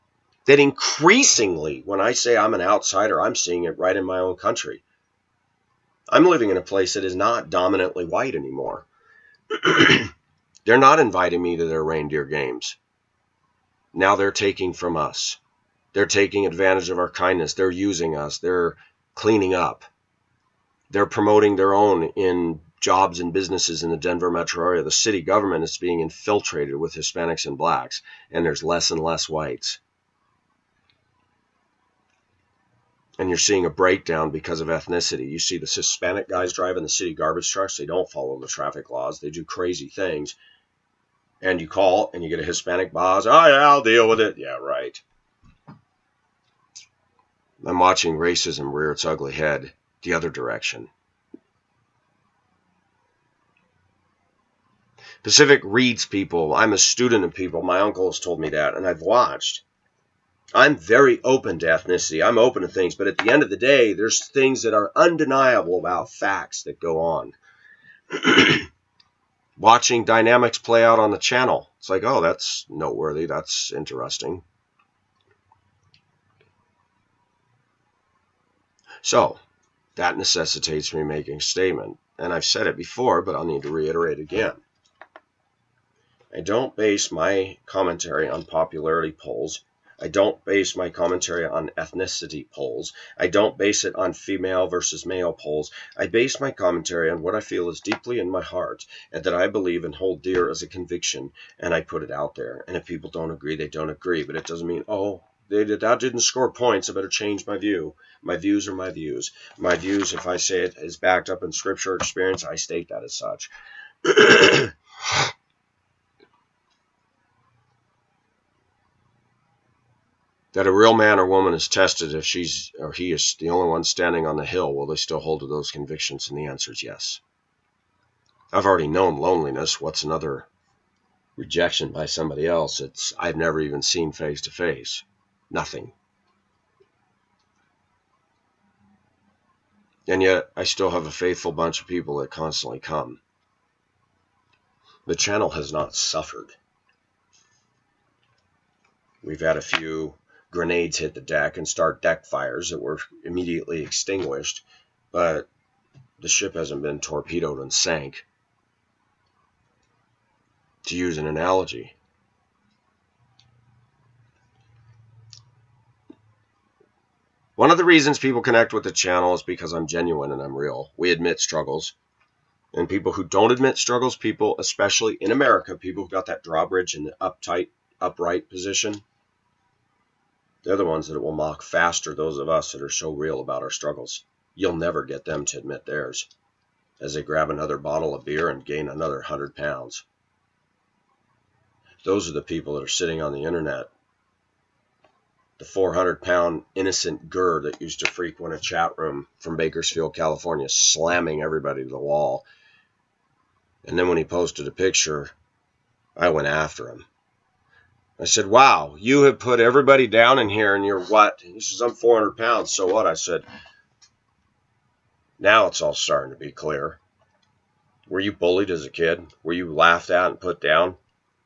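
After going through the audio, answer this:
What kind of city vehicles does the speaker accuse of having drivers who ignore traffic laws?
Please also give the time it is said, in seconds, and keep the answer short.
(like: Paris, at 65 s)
garbage trucks, at 37 s.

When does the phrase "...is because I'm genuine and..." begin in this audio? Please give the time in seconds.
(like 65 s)
169 s.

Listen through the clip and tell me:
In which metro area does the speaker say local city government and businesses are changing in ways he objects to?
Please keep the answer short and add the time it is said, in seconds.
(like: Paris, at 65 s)
Denver, at 23 s.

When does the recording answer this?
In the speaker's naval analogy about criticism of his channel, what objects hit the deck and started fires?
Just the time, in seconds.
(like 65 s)
150 s.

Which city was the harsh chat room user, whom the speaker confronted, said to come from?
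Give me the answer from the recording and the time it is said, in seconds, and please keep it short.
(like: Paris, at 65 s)
Bakersfield, California, at 199 s.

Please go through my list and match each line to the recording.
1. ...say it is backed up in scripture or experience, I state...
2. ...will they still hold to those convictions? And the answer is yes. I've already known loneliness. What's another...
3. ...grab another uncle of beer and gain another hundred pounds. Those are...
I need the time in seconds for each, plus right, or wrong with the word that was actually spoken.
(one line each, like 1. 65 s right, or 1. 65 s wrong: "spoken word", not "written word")
1. 110 s right
2. 124 s right
3. 187 s wrong: "bottle", not "uncle".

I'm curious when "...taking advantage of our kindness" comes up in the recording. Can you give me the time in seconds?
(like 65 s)
16 s.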